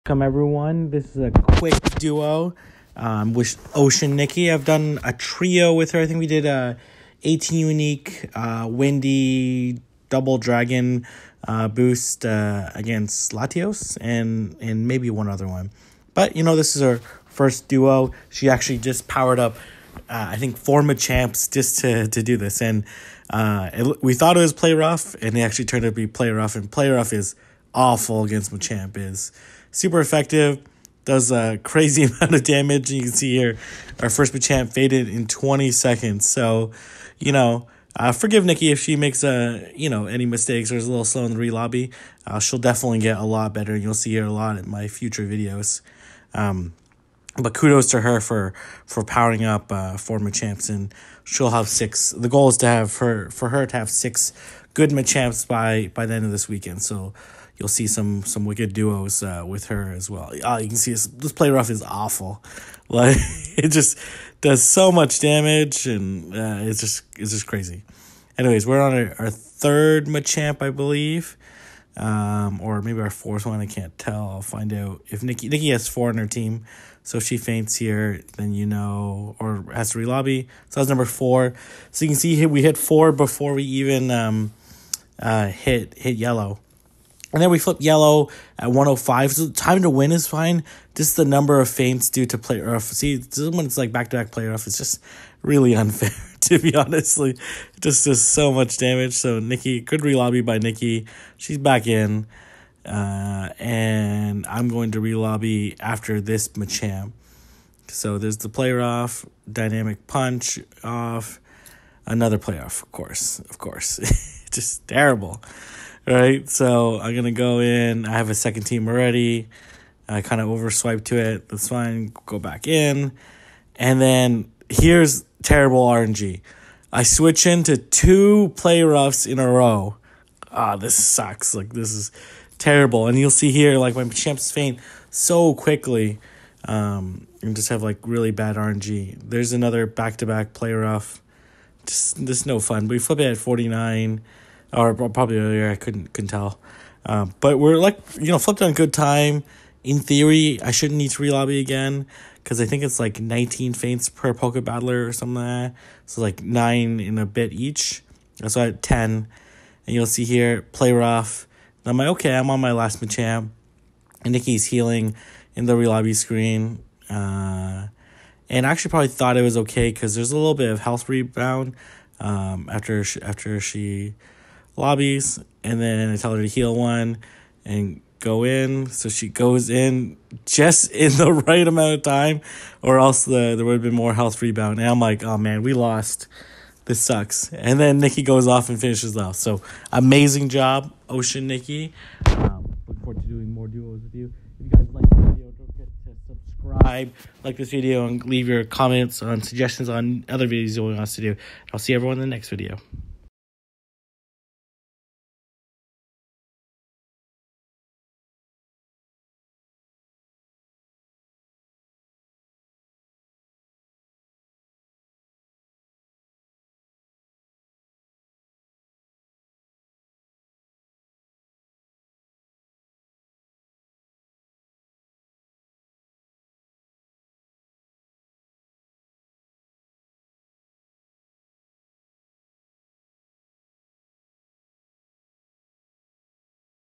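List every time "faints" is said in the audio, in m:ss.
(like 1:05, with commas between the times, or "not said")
1:17, 1:31, 2:14, 2:33.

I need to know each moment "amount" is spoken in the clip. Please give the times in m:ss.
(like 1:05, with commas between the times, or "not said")
0:32, 3:01.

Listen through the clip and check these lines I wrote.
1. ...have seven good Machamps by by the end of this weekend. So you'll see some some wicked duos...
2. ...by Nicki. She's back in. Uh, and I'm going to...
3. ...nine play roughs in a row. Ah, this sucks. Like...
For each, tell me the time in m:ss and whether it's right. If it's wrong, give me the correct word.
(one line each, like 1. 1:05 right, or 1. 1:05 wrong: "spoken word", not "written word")
1. 0:53 wrong: "six", not "seven"
2. 1:40 right
3. 2:07 wrong: "two", not "nine".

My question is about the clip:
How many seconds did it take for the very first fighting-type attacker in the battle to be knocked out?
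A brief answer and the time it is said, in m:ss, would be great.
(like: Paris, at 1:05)
20, at 0:35.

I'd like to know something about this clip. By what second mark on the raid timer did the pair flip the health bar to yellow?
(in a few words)
105.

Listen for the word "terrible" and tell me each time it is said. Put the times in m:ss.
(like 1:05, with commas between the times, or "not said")
1:54, 2:05, 2:12.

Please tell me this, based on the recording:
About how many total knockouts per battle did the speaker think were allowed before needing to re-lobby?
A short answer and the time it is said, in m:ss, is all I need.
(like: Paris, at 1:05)
19, at 2:33.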